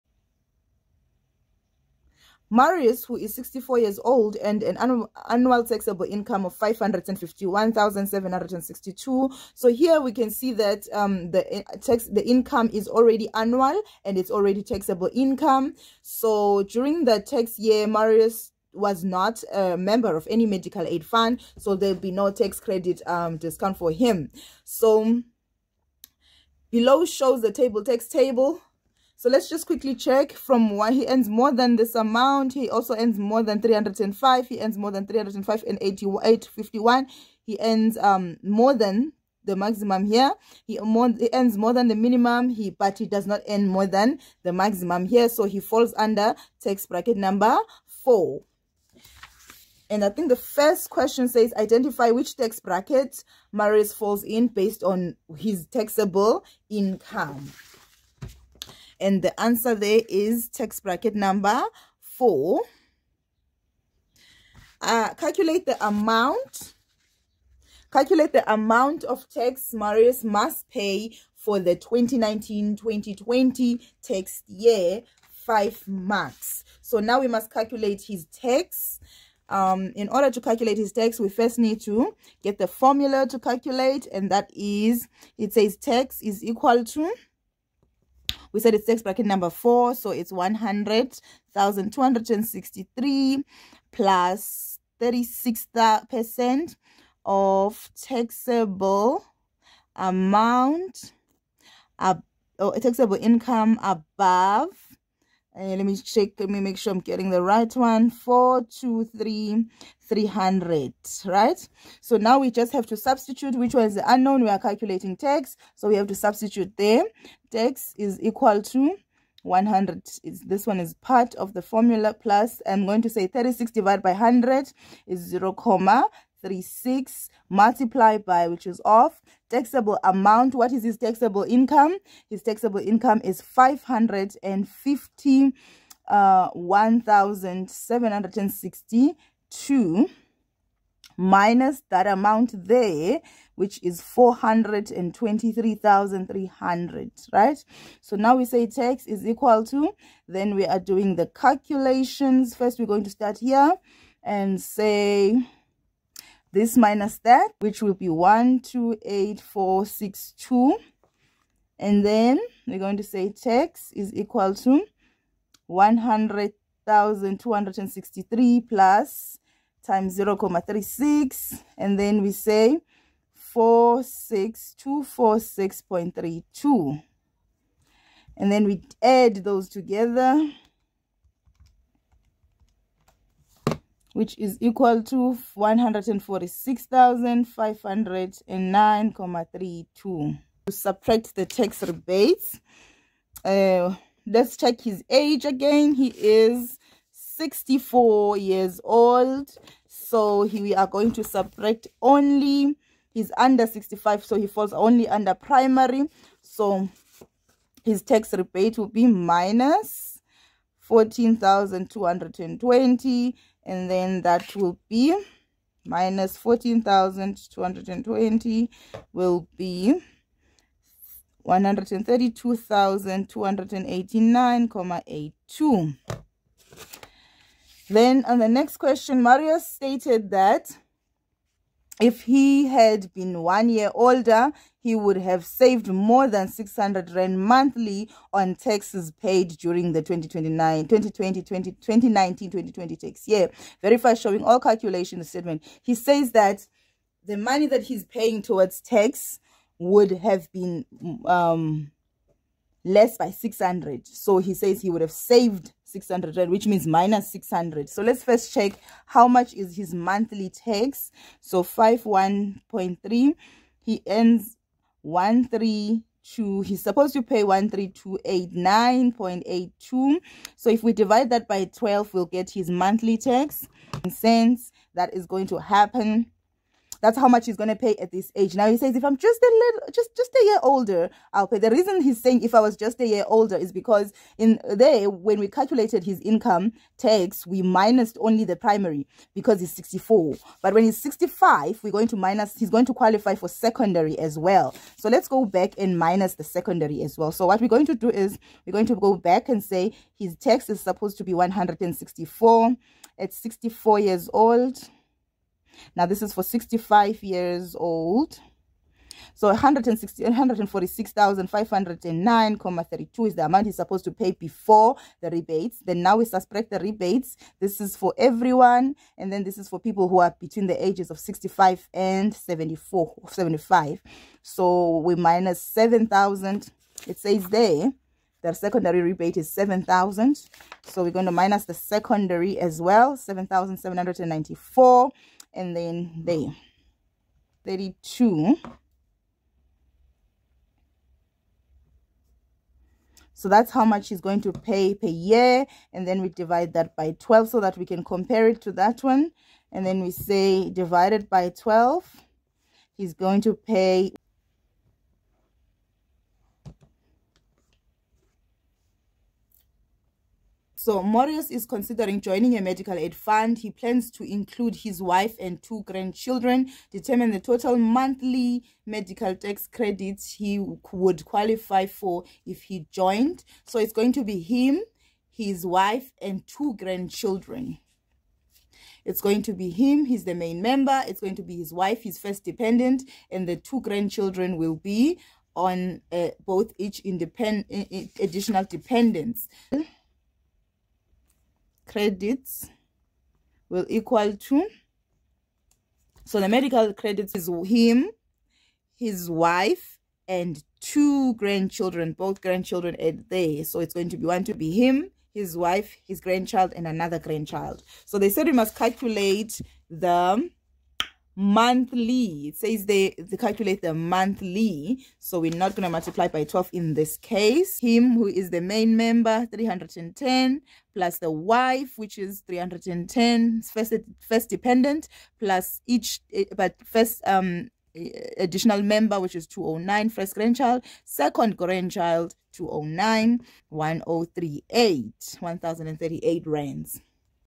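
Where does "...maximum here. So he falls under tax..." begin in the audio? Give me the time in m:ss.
0:44.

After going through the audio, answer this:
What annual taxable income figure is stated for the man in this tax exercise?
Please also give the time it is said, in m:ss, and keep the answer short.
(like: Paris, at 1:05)
551,762, at 0:06.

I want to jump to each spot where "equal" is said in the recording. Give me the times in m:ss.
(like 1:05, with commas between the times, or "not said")
1:26, 1:58, 2:29, 2:44, 3:04, 6:33.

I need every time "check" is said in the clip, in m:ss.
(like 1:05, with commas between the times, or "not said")
0:29, 1:45, 3:14, 4:18.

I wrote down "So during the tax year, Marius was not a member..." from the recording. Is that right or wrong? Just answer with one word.
right.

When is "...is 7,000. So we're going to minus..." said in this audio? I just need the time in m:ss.
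5:29.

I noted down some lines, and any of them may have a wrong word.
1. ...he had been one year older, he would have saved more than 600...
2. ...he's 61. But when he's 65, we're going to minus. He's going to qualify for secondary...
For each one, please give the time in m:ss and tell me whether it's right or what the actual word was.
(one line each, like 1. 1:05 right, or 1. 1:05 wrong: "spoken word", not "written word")
1. 3:52 right
2. 4:49 wrong: "64", not "61".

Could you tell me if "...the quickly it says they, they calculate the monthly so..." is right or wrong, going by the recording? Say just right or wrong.
wrong.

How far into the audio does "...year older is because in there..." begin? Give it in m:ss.
4:43.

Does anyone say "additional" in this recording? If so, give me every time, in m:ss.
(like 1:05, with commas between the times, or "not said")
6:28, 7:08.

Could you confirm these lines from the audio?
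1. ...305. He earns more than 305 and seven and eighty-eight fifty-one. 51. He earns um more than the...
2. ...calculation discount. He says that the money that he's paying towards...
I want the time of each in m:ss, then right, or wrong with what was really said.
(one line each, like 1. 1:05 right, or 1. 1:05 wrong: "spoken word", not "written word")
1. 0:33 wrong: "five", not "seven"
2. 4:04 wrong: "statement", not "discount".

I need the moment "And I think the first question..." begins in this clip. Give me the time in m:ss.
0:49.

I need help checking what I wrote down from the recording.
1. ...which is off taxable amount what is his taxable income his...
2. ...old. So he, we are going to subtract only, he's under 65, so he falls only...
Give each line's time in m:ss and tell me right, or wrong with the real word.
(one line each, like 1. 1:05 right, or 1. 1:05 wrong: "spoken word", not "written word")
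1. 2:08 right
2. 3:18 right.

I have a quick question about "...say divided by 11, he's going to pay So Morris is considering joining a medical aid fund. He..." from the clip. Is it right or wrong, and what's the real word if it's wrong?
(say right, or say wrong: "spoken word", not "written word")
wrong: "12", not "11".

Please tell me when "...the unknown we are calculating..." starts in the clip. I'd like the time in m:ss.
1:53.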